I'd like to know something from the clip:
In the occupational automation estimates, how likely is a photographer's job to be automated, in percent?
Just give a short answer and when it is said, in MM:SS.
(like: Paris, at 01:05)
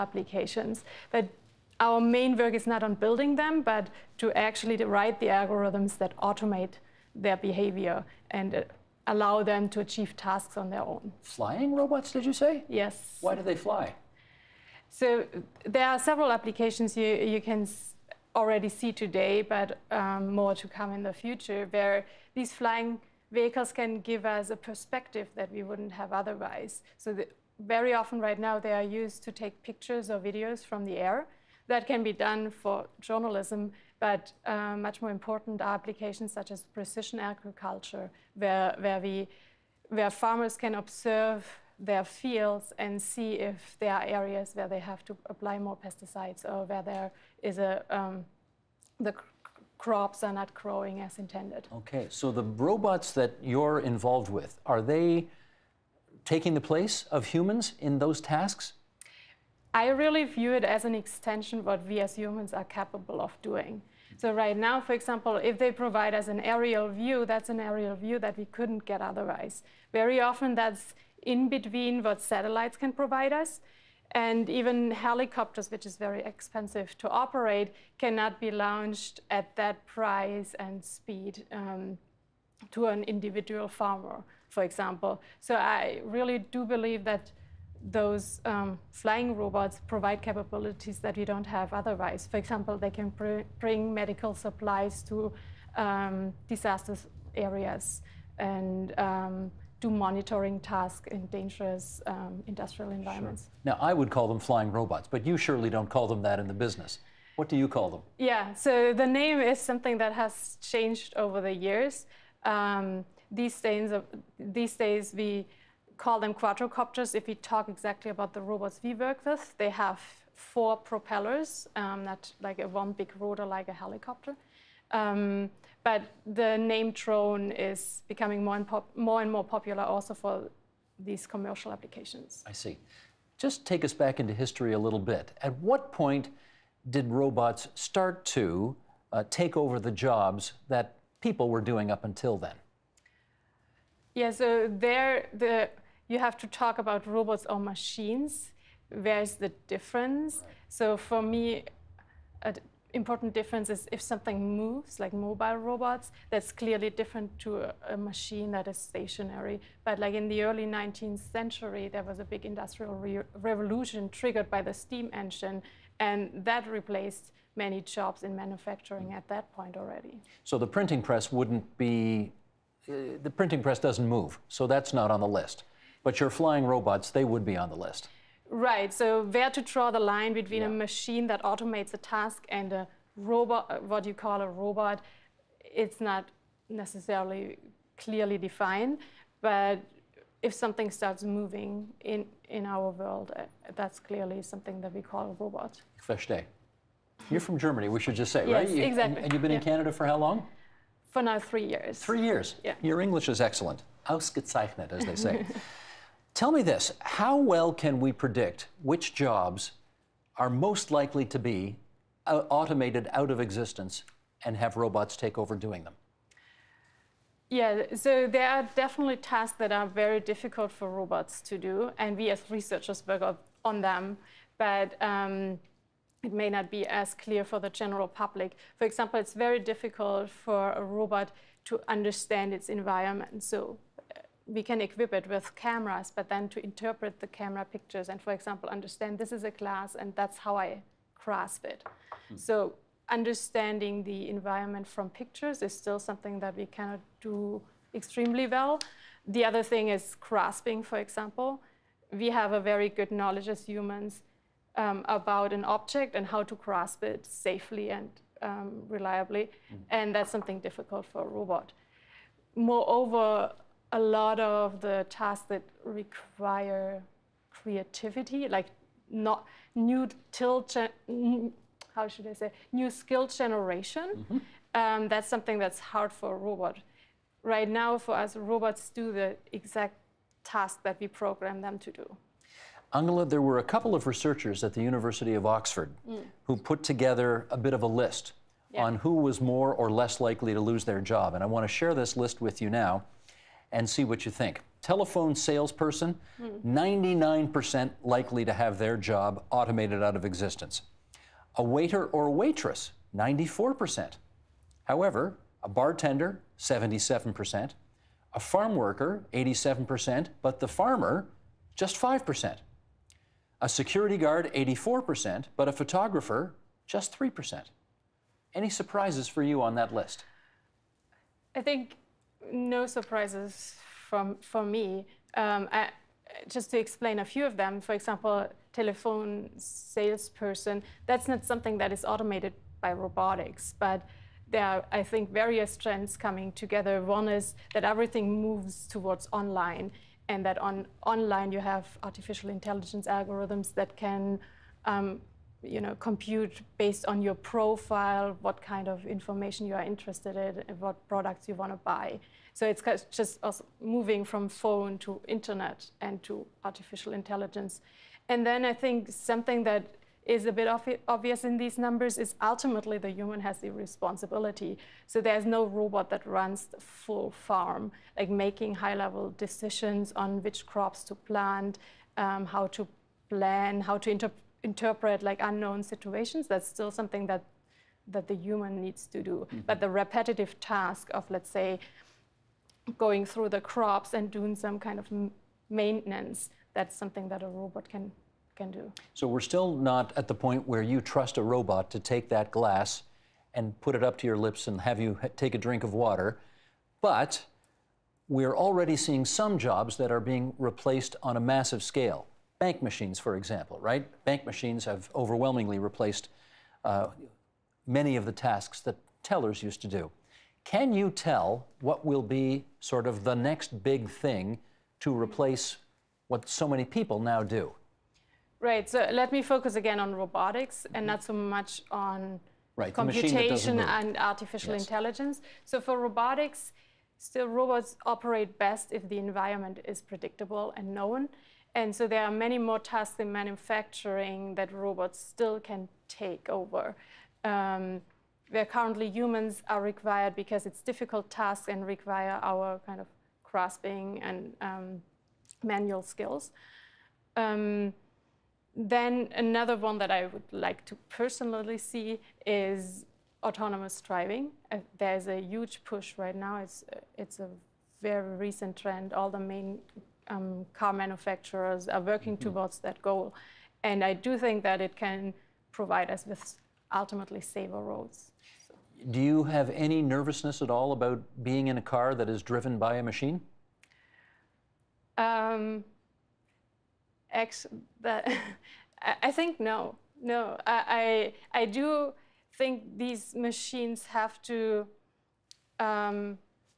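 3%, at 05:17.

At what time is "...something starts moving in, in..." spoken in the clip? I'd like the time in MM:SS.
03:10.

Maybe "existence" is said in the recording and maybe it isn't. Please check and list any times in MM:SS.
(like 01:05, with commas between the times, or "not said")
03:33, 05:00.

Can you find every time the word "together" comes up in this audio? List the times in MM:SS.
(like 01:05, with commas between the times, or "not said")
04:46, 05:36.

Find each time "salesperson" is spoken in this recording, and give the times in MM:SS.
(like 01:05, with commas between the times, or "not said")
04:55, 05:29.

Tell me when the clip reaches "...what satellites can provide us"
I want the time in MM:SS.
01:12.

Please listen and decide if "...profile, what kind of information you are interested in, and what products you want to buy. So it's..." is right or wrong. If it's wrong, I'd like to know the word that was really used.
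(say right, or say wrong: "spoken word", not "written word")
right.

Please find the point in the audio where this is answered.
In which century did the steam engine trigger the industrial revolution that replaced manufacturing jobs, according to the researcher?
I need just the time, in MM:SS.
02:40.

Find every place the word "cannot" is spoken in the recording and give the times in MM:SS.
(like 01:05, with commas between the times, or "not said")
01:17, 04:06.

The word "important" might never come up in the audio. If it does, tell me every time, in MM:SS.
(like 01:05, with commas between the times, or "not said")
00:35, 02:32.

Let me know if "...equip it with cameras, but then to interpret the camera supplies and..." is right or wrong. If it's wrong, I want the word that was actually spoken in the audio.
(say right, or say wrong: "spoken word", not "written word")
wrong: "pictures", not "supplies".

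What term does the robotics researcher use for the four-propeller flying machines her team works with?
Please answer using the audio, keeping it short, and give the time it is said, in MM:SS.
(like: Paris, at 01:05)
quadrocopters, at 01:56.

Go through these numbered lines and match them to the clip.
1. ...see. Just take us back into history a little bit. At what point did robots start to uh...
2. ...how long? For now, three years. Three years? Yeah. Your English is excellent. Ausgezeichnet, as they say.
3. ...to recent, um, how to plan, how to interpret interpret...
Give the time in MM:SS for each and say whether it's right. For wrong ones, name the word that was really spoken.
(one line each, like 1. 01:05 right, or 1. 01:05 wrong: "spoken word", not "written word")
1. 02:12 right
2. 03:20 right
3. 06:11 wrong: "plant", not "recent".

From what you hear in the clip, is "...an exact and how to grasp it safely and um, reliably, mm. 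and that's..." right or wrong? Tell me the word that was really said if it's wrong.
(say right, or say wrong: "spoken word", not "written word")
wrong: "object", not "exact".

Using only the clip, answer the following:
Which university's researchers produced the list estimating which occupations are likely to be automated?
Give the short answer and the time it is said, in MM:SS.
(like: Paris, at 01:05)
University of Oxford, at 04:44.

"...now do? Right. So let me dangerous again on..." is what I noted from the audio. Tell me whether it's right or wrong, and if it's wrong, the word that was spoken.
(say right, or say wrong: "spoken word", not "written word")
wrong: "focus", not "dangerous".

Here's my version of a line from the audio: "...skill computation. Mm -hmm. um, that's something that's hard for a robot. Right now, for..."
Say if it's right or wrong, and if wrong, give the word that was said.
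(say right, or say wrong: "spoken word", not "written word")
wrong: "generation", not "computation".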